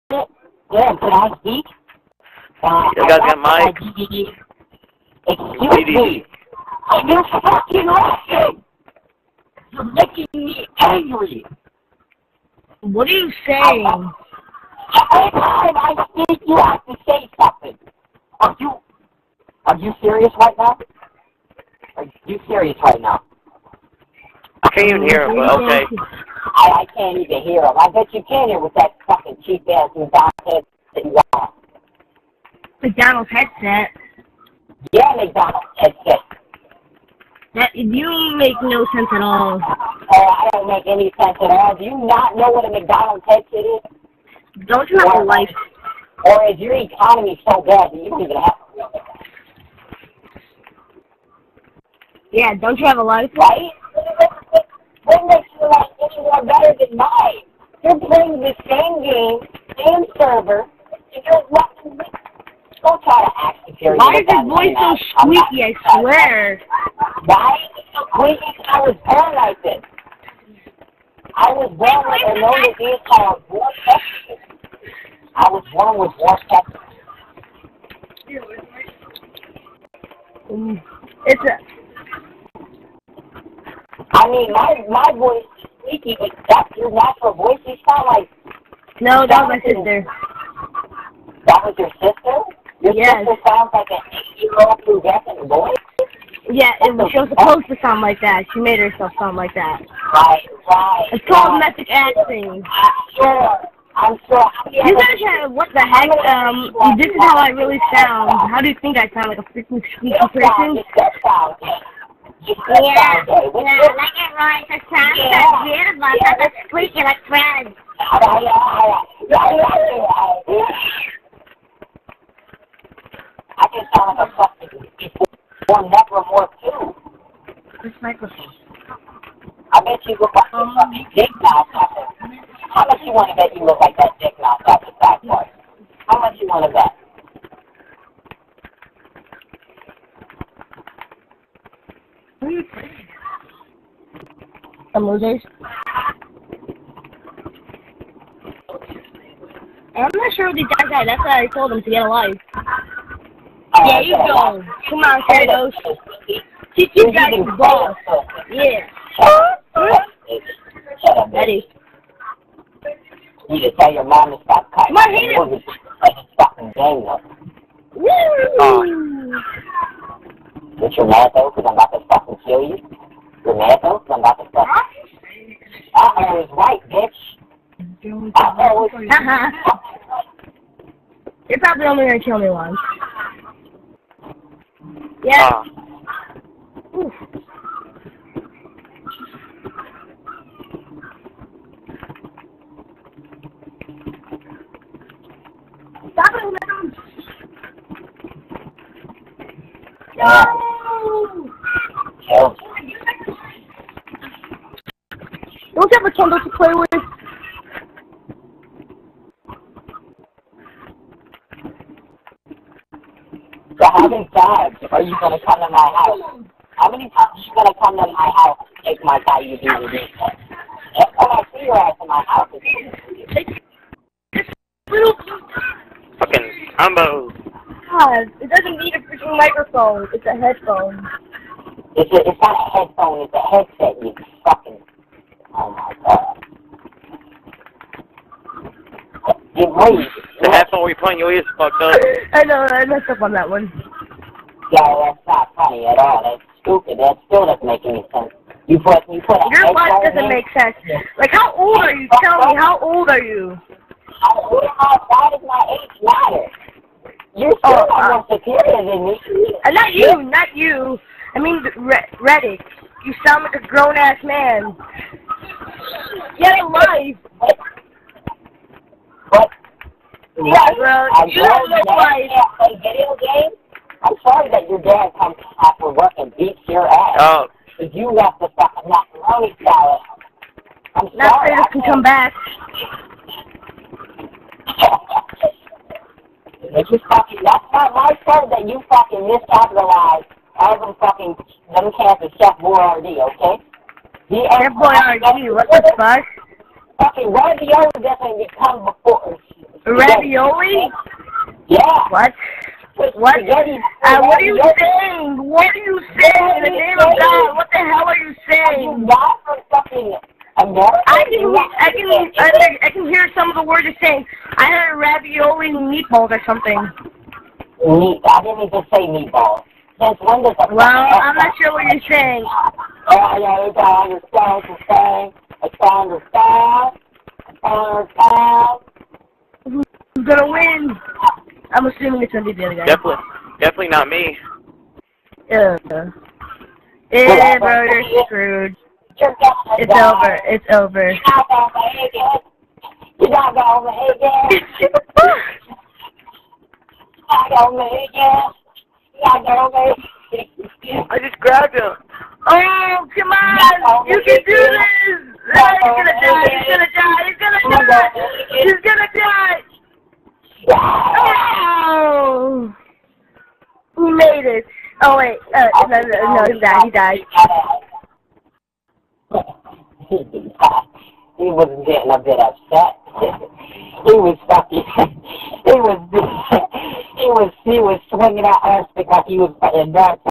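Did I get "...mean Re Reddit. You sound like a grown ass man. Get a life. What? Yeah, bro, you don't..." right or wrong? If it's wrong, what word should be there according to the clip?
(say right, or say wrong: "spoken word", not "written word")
right.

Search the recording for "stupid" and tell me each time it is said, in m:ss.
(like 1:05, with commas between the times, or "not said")
4:06.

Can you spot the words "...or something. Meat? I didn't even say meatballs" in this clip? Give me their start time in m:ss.
5:16.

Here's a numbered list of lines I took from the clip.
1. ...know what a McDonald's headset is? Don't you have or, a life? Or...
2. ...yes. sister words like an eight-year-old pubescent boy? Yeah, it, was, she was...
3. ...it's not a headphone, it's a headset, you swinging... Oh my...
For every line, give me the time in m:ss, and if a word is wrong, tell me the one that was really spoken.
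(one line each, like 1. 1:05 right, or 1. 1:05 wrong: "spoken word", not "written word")
1. 0:42 right
2. 1:32 wrong: "sounds", not "words"
3. 3:52 wrong: "fucking", not "swinging".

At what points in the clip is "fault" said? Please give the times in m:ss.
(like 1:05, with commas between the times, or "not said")
4:48.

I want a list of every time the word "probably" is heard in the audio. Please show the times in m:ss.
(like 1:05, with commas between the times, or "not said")
3:01.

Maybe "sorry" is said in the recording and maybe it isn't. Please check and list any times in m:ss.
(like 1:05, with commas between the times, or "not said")
4:41.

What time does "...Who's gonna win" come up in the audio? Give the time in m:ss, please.
5:30.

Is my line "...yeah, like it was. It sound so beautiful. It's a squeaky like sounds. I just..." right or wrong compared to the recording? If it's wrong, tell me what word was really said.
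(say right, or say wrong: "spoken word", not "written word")
wrong: "friends", not "sounds".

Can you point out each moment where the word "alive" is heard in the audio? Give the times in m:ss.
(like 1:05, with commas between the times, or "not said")
2:32.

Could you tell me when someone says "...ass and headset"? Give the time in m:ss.
0:29.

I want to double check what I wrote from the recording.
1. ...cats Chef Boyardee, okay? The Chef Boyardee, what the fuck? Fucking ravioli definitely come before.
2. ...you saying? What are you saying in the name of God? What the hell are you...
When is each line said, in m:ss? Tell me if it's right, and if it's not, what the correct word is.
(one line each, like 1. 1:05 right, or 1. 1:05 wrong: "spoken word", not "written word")
1. 4:51 right
2. 5:04 right.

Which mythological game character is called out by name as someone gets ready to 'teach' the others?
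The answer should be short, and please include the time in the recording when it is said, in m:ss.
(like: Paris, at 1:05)
Kratos, at 2:35.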